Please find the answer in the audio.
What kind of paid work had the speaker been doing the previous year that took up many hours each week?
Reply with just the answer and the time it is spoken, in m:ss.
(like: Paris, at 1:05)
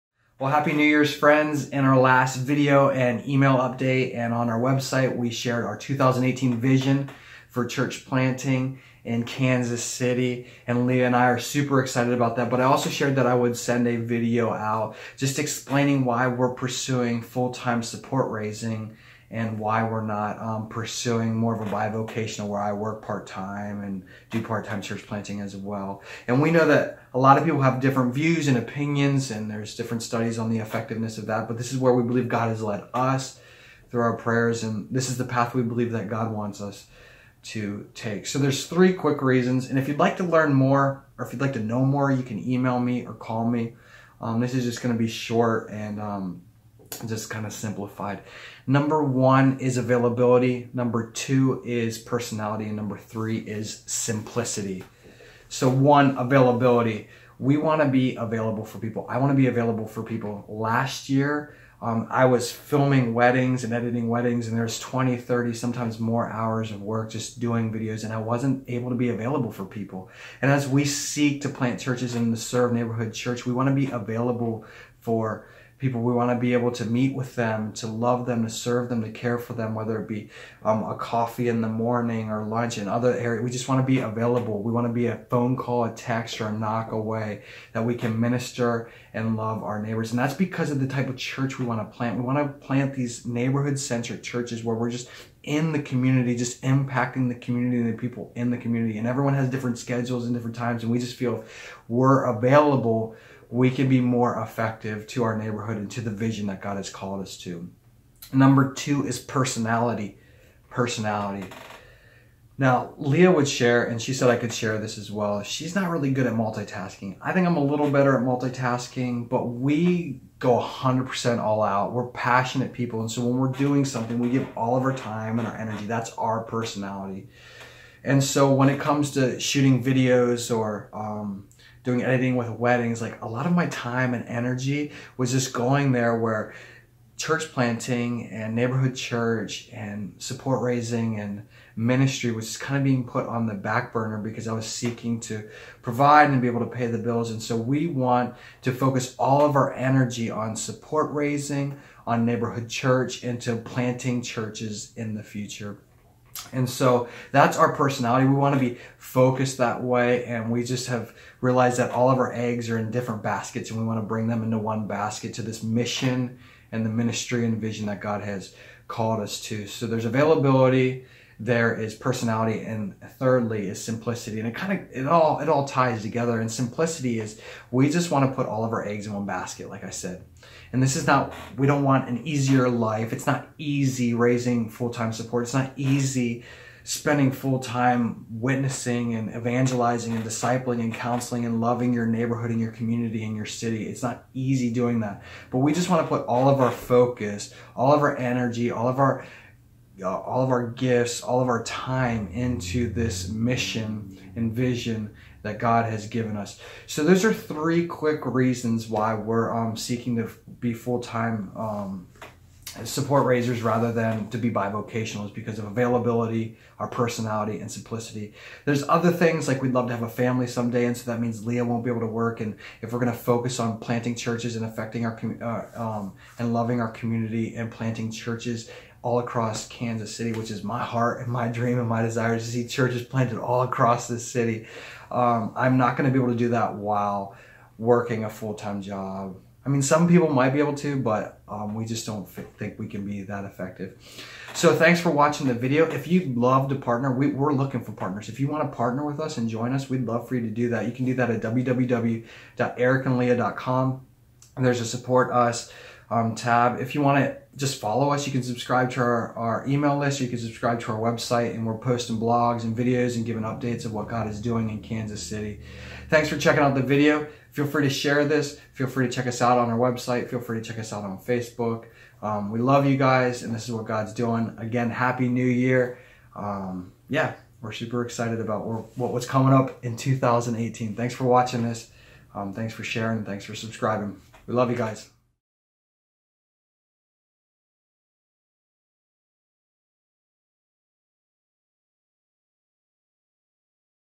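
filming weddings, at 1:02.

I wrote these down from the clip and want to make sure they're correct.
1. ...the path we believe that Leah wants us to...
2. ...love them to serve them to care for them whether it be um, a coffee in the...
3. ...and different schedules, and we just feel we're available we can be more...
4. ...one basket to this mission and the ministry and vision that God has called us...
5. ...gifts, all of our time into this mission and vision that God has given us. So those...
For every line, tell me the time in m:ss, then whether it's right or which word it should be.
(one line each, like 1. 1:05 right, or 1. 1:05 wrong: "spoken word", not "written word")
1. 0:35 wrong: "God", not "Leah"
2. 1:17 right
3. 1:40 wrong: "times", not "schedules"
4. 2:44 right
5. 3:20 right.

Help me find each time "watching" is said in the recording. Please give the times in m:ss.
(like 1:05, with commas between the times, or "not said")
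4:05, 4:41.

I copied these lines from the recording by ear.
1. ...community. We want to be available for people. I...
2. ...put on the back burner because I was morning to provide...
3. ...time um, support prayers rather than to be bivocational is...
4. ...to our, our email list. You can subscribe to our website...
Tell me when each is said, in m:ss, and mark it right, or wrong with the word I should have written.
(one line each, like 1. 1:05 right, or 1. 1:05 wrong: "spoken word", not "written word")
1. 0:56 wrong: "availability", not "community"
2. 2:23 wrong: "seeking", not "morning"
3. 3:30 wrong: "raisers", not "prayers"
4. 4:18 right.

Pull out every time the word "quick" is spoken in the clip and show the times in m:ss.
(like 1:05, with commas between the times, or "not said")
0:38, 3:27.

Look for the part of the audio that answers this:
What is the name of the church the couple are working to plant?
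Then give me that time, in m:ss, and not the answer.
1:12.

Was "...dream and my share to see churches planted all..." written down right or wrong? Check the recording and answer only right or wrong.
wrong.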